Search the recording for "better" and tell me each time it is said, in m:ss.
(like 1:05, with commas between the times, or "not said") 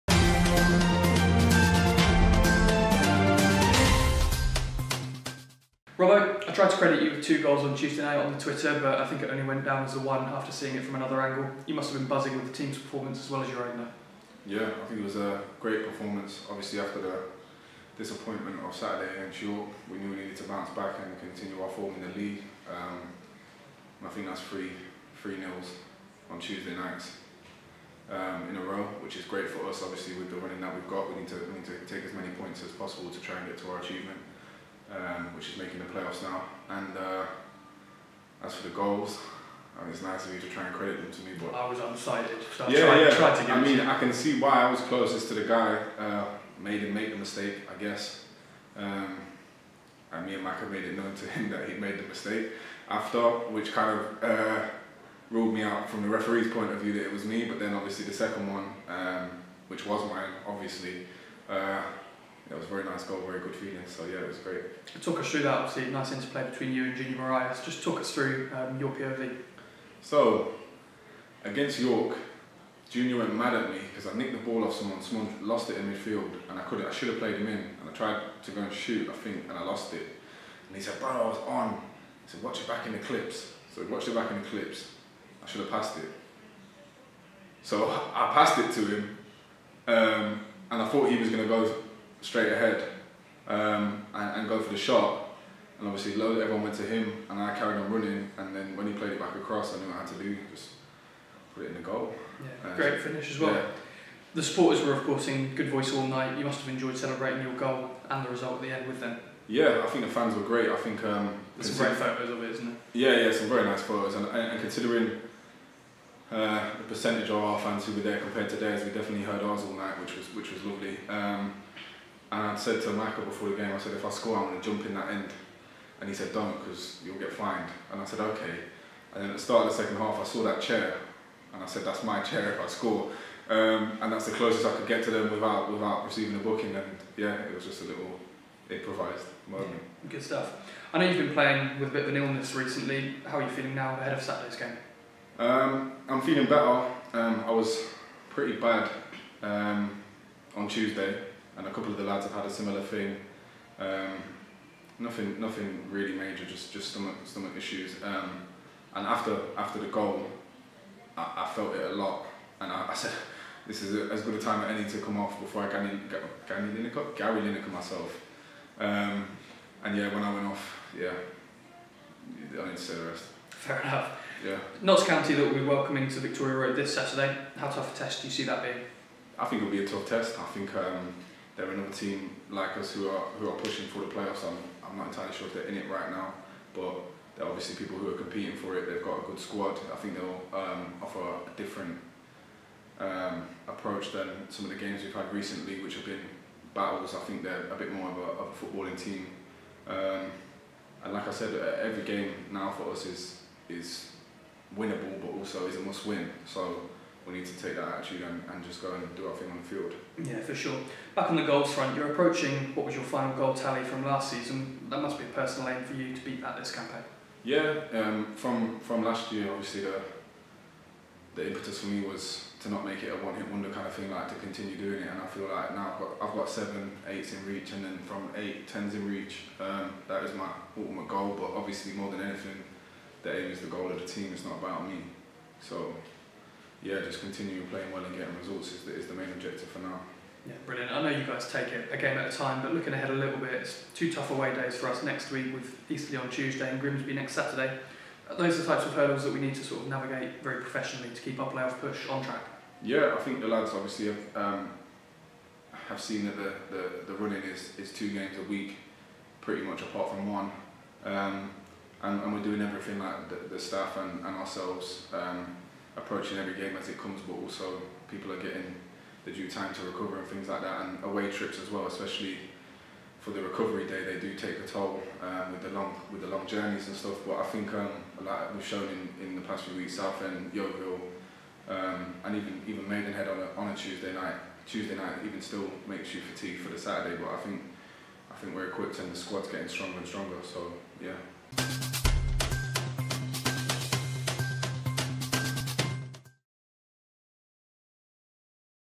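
2:26.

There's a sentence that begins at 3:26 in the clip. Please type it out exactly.
So we need to take that attitude and, and just go and do our thing on the field.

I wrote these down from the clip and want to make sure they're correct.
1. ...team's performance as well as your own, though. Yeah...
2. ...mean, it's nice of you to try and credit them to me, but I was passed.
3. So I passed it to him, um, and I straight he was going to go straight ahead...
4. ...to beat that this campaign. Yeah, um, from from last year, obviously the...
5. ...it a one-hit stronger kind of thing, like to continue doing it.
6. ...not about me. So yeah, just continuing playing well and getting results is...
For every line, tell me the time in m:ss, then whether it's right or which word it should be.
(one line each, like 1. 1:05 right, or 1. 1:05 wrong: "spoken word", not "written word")
1. 0:12 right
2. 0:39 wrong: "undecided", not "passed"
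3. 1:27 wrong: "thought", not "straight"
4. 3:36 right
5. 3:43 wrong: "wonder", not "stronger"
6. 3:54 right.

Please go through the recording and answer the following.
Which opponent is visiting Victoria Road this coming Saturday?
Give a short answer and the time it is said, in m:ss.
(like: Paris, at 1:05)
Notts County, at 2:54.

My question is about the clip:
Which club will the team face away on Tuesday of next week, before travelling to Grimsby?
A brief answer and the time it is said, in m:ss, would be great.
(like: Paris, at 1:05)
Eastleigh, at 4:05.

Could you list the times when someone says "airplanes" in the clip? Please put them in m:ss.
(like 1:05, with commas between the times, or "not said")
not said.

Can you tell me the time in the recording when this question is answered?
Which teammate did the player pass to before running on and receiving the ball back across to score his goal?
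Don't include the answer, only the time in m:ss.
1:06.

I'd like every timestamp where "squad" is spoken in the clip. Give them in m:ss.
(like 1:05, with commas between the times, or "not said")
3:09, 4:49.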